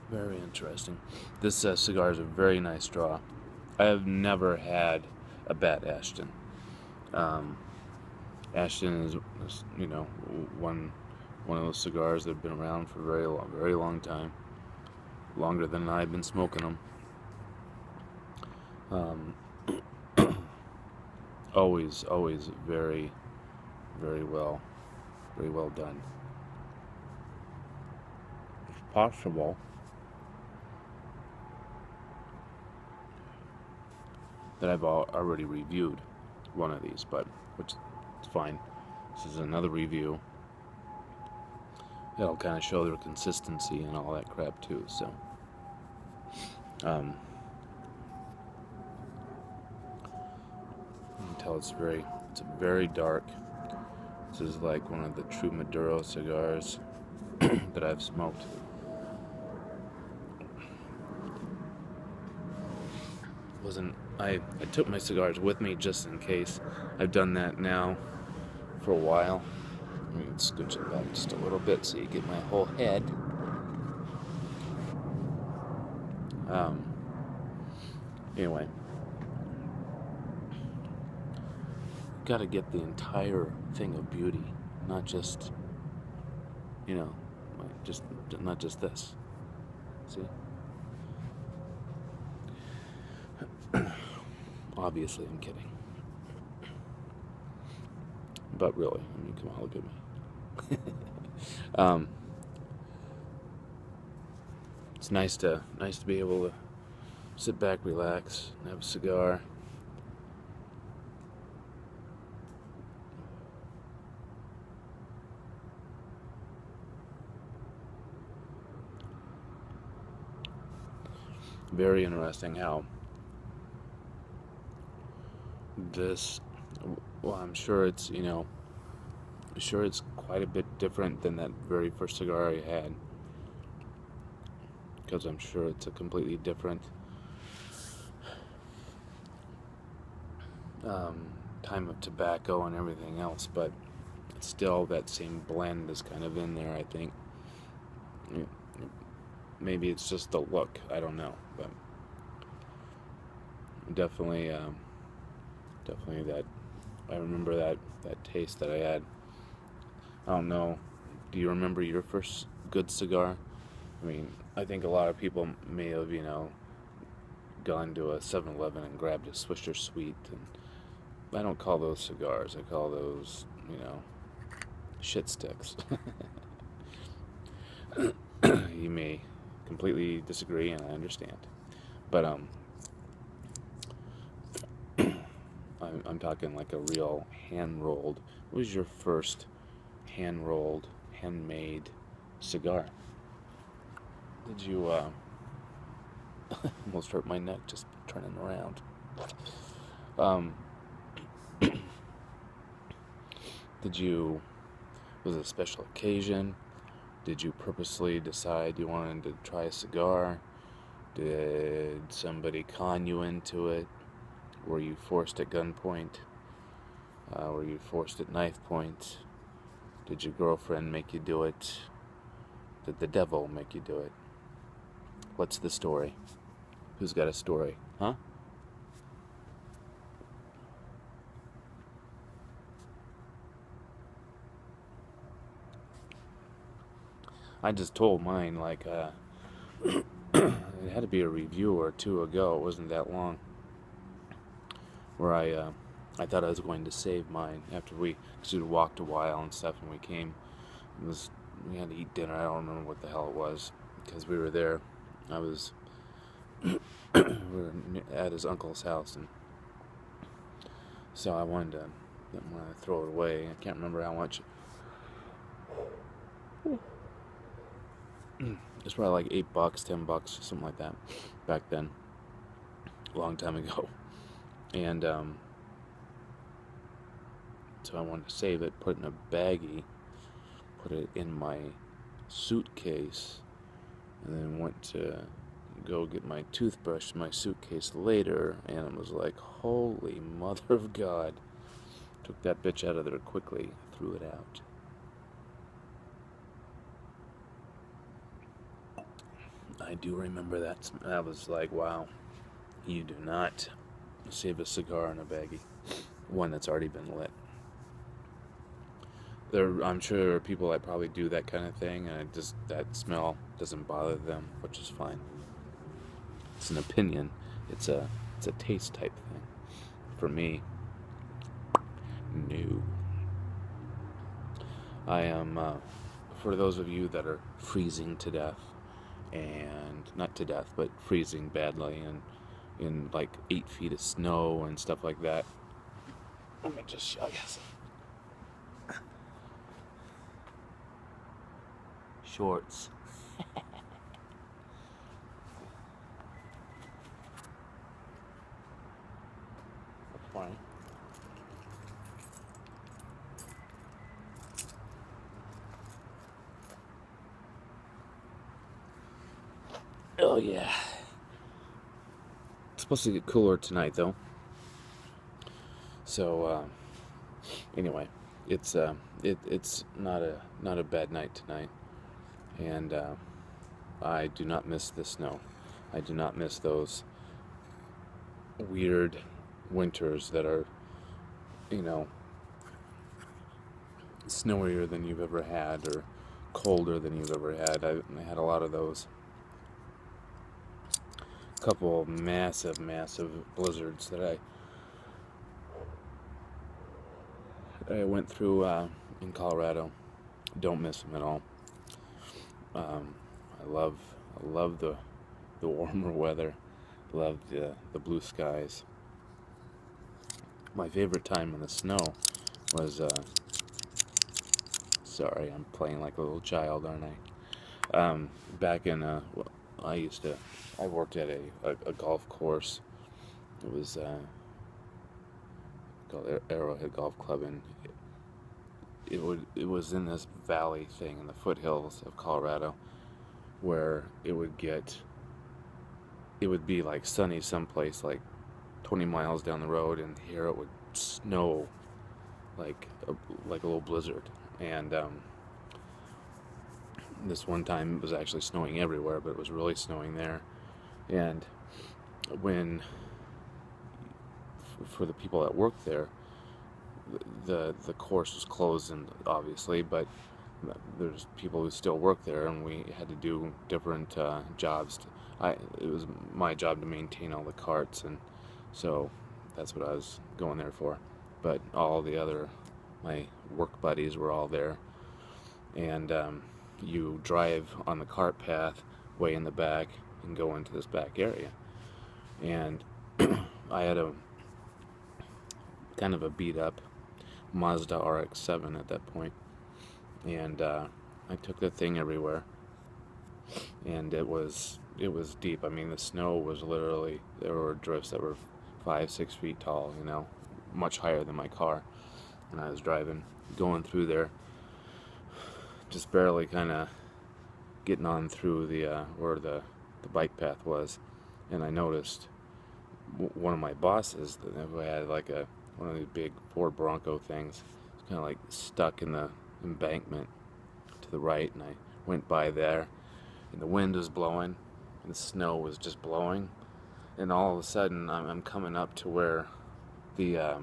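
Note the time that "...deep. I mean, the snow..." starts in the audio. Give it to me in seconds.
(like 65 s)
495 s.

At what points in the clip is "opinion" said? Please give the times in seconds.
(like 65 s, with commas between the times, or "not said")
316 s.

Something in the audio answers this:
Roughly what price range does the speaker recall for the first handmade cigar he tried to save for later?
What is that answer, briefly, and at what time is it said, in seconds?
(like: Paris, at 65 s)
8 to 10 dollars, at 269 s.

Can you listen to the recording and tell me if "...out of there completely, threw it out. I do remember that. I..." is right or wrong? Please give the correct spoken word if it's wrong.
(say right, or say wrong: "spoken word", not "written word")
wrong: "quickly", not "completely".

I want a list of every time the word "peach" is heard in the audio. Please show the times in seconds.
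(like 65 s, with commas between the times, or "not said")
not said.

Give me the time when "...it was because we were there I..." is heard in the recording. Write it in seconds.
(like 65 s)
253 s.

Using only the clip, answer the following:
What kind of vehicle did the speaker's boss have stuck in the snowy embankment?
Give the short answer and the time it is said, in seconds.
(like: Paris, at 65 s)
Ford Bronco, at 516 s.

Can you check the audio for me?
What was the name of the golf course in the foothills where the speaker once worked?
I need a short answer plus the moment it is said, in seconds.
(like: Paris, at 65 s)
Arrowhead Golf Club, at 426 s.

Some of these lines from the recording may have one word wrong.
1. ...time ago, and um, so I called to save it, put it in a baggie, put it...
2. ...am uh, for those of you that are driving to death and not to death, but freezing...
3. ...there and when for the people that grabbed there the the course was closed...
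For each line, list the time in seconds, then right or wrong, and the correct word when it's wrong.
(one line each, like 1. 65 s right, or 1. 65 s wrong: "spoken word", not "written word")
1. 273 s wrong: "wanted", not "called"
2. 325 s wrong: "freezing", not "driving"
3. 450 s wrong: "worked", not "grabbed".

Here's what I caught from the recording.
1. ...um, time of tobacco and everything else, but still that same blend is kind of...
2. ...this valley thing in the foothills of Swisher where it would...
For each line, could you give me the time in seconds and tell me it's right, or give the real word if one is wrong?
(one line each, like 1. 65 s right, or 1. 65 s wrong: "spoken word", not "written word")
1. 140 s right
2. 430 s wrong: "Colorado", not "Swisher".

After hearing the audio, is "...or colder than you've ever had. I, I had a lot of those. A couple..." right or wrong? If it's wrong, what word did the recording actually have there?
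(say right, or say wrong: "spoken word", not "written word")
right.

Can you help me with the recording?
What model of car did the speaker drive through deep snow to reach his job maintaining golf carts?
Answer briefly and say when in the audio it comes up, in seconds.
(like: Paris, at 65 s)
Mazda RX-7, at 487 s.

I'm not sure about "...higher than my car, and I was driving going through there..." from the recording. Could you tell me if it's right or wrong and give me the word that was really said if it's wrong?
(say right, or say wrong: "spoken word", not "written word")
right.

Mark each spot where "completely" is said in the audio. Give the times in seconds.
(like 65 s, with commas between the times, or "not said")
135 s, 179 s.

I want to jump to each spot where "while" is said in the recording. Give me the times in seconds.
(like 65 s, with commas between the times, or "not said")
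68 s, 249 s.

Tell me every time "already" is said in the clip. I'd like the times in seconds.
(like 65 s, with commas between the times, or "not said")
34 s, 306 s.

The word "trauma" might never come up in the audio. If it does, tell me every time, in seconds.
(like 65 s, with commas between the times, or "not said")
not said.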